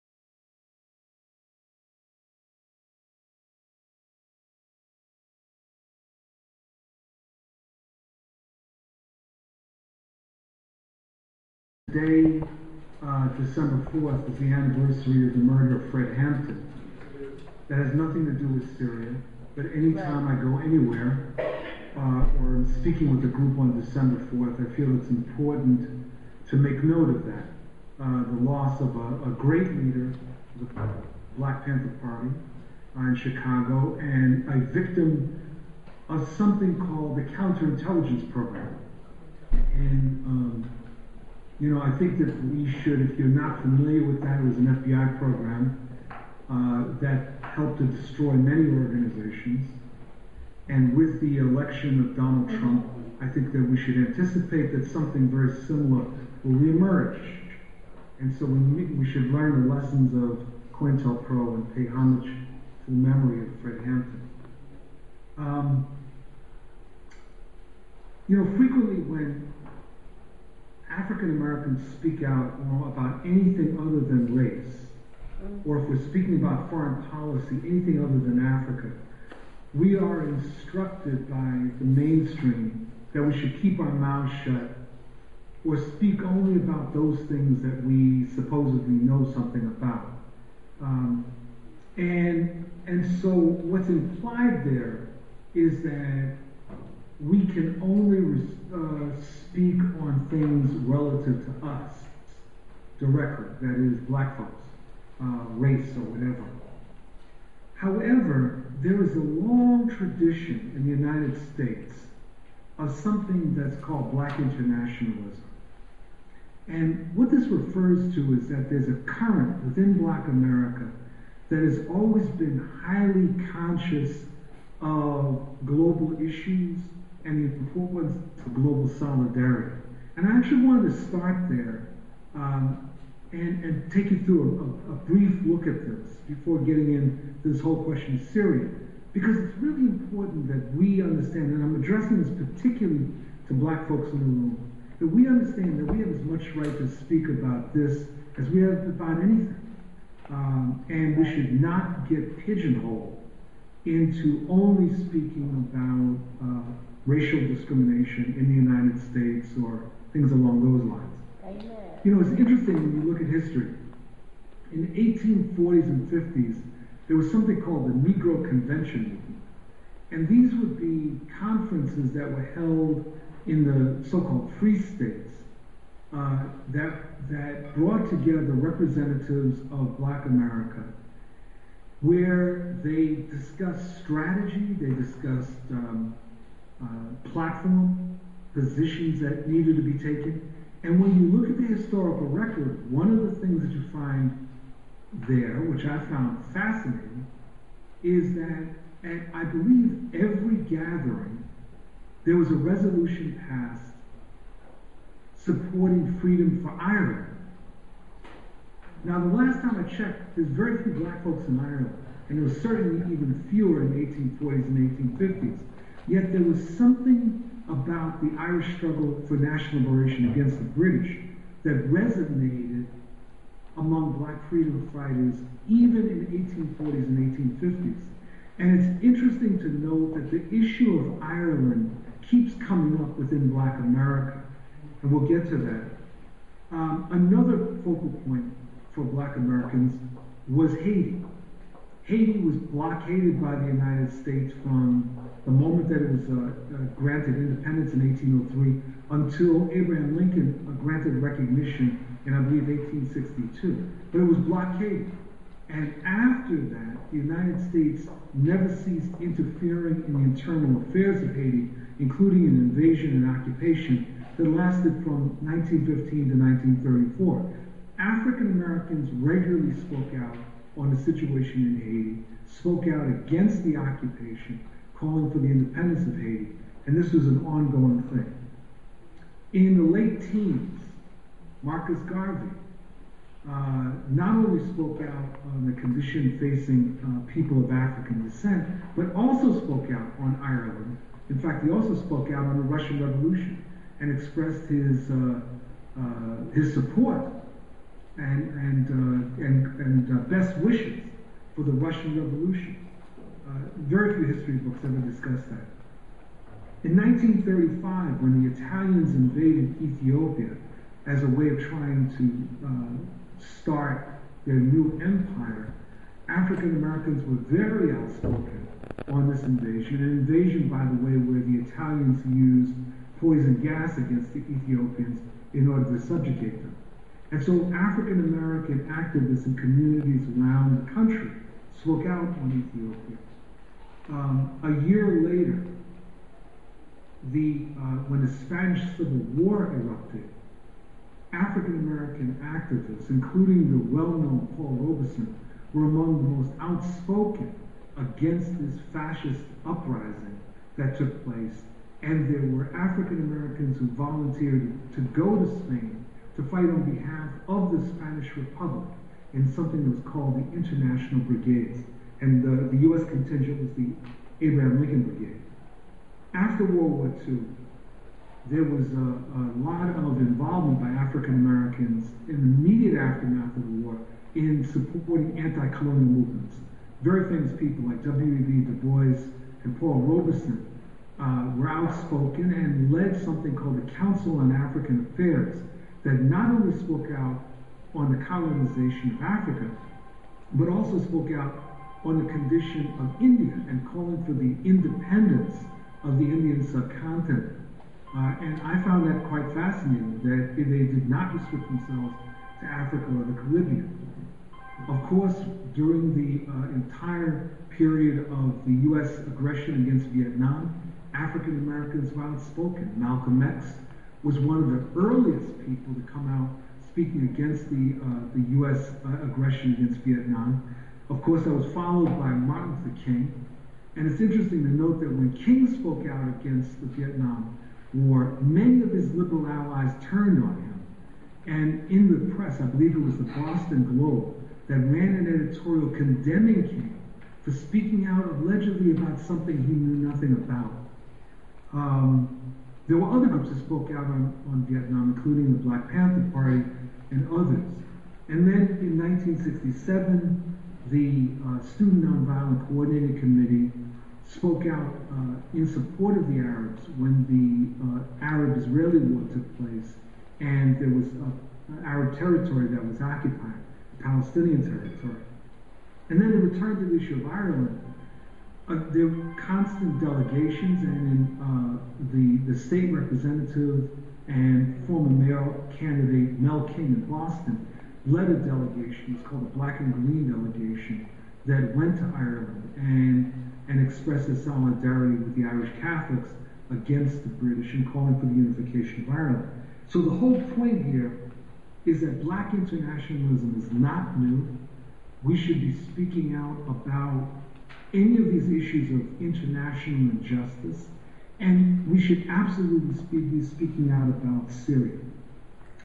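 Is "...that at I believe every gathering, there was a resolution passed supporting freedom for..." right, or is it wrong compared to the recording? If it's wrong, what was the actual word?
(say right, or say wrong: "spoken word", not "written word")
right.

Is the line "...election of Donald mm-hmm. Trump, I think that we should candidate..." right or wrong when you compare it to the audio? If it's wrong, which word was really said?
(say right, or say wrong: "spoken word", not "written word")
wrong: "anticipate", not "candidate".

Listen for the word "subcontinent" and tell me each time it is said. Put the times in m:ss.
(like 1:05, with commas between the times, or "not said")
6:36.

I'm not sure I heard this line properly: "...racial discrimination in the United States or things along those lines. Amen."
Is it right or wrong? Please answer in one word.
right.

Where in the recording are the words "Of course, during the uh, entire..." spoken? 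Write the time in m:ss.
6:44.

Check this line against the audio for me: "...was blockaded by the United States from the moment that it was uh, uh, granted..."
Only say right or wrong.
right.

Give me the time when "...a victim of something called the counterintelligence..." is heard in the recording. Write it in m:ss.
0:34.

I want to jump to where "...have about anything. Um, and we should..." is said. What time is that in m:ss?
2:28.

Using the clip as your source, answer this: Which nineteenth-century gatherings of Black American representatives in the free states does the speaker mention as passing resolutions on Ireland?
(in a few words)
Negro Convention movement.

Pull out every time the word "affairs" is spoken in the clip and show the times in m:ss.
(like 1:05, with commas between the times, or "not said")
4:20, 6:25.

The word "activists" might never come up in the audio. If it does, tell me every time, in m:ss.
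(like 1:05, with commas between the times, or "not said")
5:28, 5:42.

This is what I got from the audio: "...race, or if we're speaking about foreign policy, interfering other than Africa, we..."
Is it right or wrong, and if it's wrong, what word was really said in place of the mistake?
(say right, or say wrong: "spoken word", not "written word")
wrong: "anything", not "interfering".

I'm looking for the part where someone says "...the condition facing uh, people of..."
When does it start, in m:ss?
4:45.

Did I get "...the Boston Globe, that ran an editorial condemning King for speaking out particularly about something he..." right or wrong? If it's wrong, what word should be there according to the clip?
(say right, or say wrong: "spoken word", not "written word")
wrong: "allegedly", not "particularly".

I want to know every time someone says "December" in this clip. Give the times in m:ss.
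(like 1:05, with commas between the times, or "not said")
0:13, 0:23.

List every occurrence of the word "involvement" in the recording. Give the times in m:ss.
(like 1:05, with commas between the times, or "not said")
6:10.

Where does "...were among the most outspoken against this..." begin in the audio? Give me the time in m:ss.
5:45.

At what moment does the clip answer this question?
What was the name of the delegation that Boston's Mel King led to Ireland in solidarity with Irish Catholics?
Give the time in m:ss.
7:59.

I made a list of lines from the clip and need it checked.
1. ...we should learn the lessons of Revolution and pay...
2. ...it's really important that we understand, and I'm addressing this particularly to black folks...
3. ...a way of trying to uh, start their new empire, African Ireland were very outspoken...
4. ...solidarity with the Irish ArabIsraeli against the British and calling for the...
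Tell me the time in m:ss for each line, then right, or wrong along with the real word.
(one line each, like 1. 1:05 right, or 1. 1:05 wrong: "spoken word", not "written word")
1. 0:58 wrong: "COINTELPRO", not "Revolution"
2. 2:19 right
3. 5:11 wrong: "Americans", not "Ireland"
4. 8:04 wrong: "Catholics", not "ArabIsraeli".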